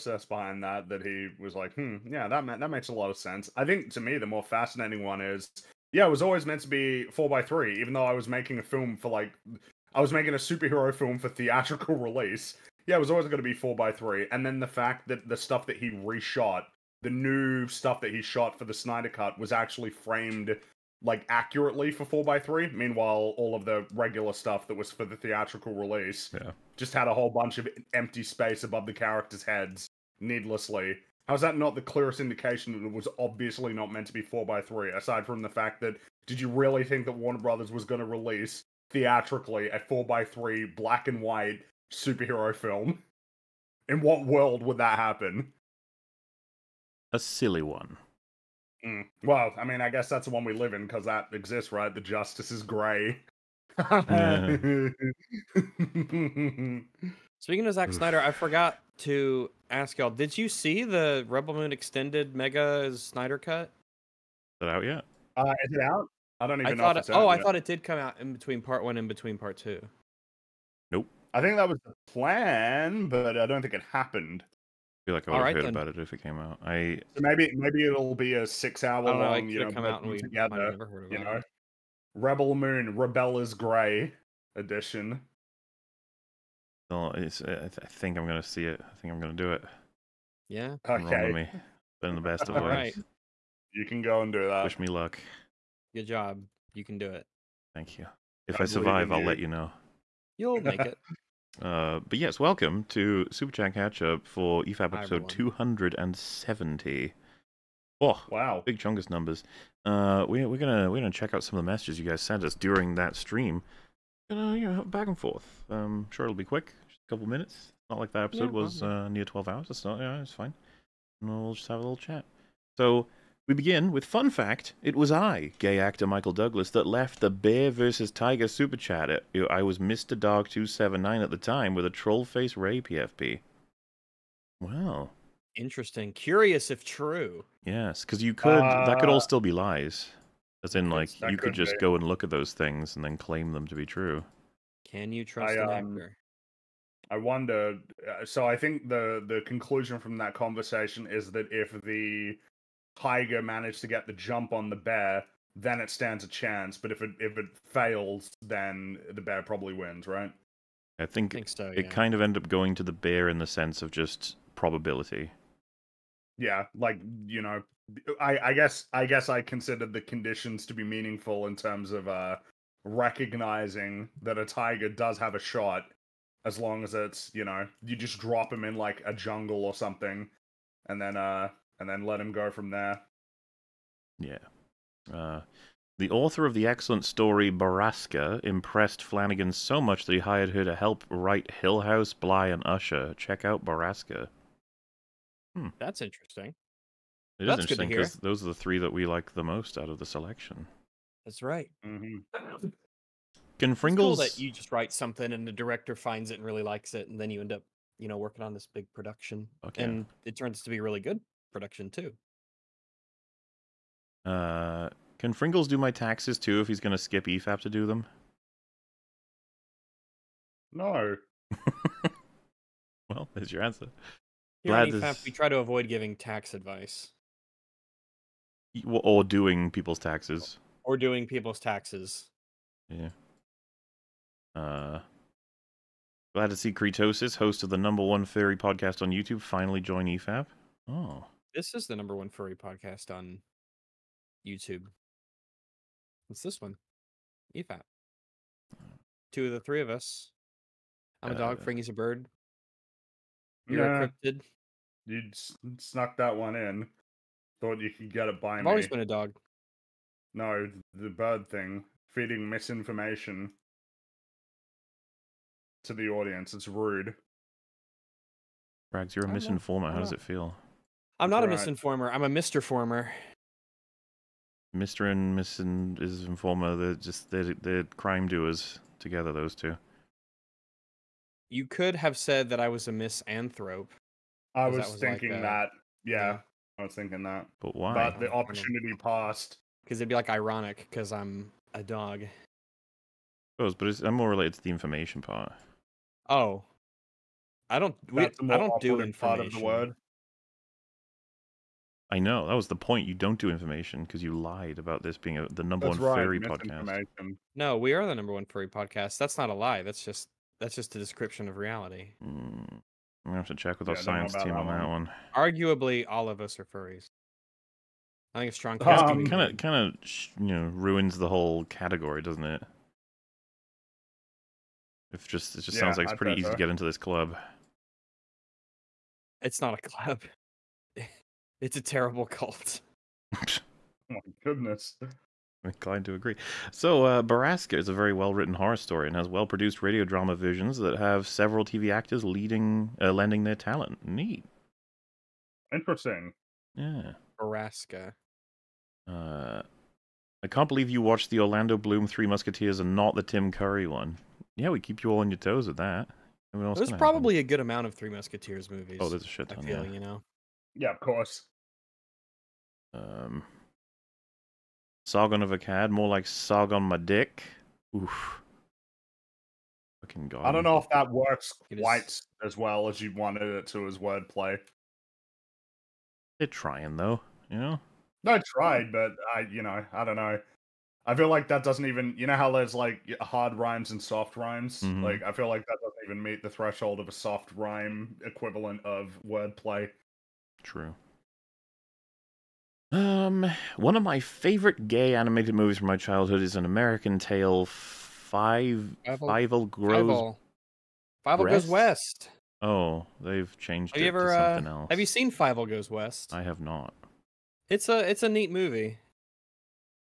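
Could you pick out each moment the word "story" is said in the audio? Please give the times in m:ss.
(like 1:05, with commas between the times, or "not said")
3:07, 5:38.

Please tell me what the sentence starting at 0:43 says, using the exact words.
In what world would that happen?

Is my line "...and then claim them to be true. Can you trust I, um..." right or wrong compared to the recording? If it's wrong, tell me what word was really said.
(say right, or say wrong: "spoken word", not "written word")
right.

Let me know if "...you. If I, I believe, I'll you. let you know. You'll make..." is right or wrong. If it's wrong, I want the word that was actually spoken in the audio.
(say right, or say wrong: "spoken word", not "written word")
wrong: "survive", not "believe".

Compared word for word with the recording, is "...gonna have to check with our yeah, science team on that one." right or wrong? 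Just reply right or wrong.
right.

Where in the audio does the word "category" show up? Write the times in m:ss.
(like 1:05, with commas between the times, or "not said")
5:21.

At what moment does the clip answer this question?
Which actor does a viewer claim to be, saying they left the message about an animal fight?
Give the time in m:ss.
2:06.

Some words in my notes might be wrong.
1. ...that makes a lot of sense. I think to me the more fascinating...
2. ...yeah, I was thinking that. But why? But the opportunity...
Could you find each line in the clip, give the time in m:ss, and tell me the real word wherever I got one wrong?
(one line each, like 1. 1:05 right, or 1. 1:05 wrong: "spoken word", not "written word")
1. 0:02 right
2. 4:46 right.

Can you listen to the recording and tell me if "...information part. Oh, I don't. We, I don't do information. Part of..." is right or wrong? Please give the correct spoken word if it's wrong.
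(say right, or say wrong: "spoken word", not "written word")
right.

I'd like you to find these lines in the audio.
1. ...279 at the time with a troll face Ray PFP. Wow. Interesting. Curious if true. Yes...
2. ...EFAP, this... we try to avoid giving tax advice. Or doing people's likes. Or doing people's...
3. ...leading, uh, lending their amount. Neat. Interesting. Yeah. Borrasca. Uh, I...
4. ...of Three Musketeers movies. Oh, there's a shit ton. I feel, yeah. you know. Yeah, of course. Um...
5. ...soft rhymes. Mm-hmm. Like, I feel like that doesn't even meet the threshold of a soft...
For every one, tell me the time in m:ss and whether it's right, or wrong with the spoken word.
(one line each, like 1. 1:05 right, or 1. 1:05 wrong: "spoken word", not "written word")
1. 2:10 right
2. 3:44 wrong: "taxes", not "likes"
3. 5:42 wrong: "talent", not "amount"
4. 5:57 right
5. 6:24 right.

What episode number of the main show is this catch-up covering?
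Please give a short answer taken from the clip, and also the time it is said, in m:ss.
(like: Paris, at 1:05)
270, at 1:44.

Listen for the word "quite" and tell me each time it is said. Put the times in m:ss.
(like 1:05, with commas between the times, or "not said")
6:11.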